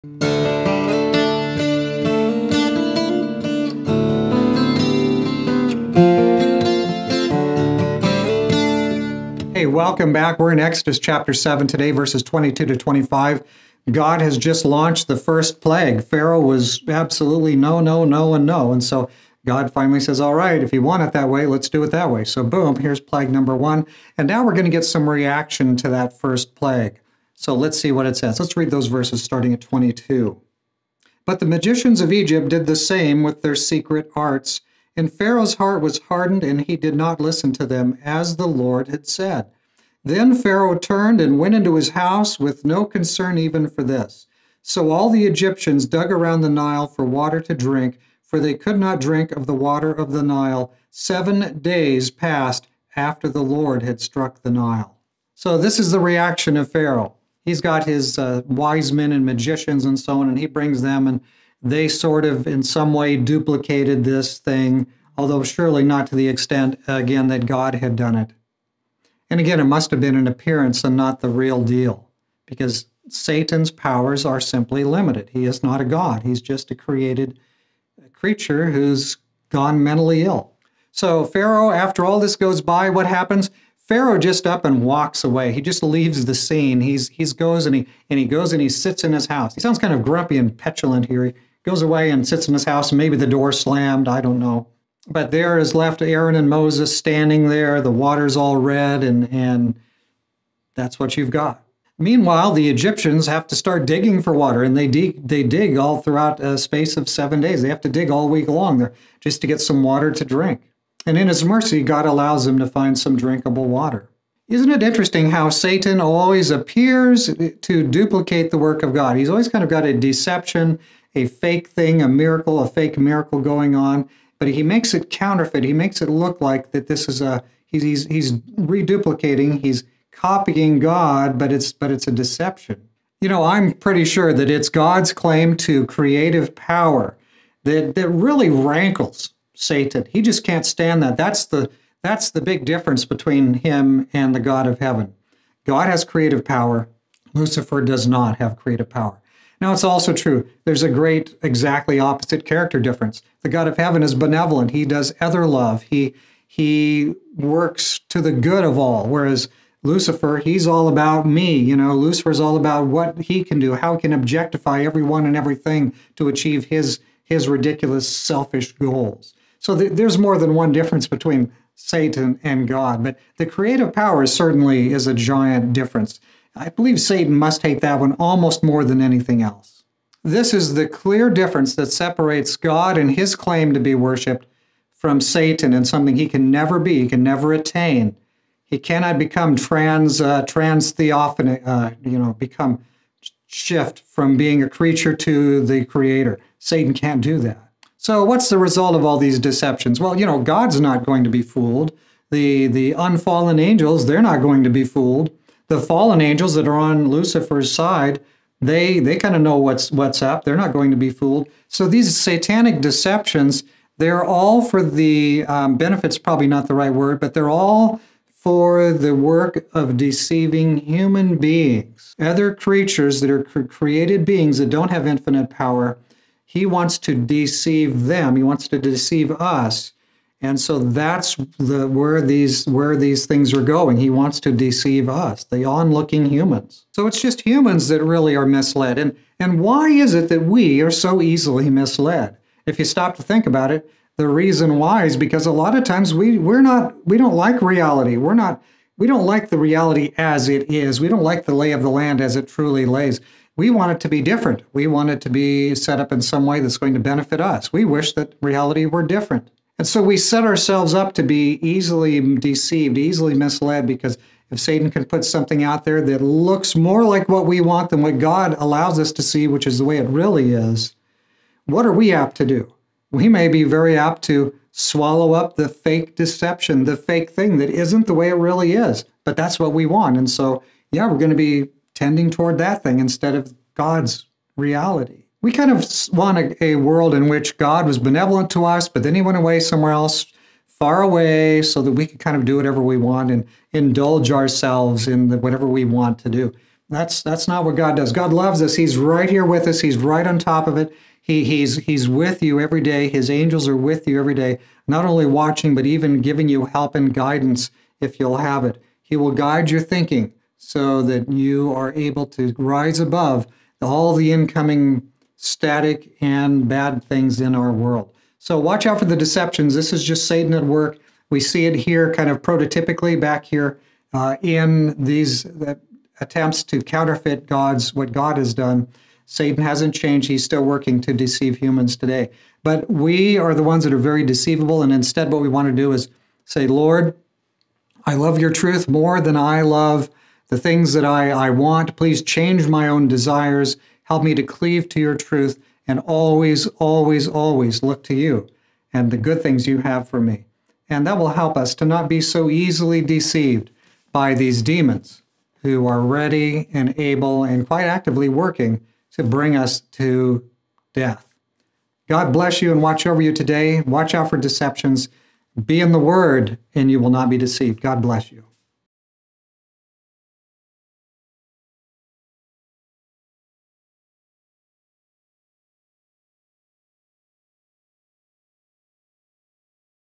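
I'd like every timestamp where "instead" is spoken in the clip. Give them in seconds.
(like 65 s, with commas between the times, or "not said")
282 s, 334 s.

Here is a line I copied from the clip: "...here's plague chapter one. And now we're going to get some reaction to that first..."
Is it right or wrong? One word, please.
wrong.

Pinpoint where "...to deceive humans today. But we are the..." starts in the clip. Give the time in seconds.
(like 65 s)
331 s.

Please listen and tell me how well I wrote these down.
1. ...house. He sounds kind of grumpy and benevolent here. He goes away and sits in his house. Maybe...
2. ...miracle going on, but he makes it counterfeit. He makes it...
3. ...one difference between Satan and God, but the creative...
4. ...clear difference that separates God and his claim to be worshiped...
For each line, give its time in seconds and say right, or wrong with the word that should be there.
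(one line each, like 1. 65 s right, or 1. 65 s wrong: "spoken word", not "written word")
1. 89 s wrong: "petulant", not "benevolent"
2. 122 s right
3. 170 s right
4. 180 s right.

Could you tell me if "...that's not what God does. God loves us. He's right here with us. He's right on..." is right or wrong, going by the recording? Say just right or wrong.
right.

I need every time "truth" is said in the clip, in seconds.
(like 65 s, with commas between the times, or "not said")
338 s, 345 s.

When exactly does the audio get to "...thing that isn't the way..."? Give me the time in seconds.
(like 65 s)
277 s.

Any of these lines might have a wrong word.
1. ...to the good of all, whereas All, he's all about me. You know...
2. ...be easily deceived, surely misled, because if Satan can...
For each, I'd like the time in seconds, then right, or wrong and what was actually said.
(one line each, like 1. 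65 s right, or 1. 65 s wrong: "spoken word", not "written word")
1. 158 s wrong: "Lucifer", not "All"
2. 261 s wrong: "easily", not "surely".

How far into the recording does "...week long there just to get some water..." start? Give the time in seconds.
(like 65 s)
108 s.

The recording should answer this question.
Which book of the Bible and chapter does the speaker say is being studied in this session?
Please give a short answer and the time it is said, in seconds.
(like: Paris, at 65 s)
Exodus 7, at 10 s.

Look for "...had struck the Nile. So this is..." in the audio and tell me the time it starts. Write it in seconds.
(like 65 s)
53 s.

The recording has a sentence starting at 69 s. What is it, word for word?
And again, it must have been an appearance and not the real deal, because Satan's powers are simply limited.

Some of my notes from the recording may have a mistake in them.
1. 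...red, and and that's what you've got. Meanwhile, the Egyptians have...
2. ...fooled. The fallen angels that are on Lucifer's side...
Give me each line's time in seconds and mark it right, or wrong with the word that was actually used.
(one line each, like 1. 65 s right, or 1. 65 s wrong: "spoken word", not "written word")
1. 98 s right
2. 204 s right.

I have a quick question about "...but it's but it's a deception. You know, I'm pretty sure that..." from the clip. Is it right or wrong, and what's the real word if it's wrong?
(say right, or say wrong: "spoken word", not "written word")
right.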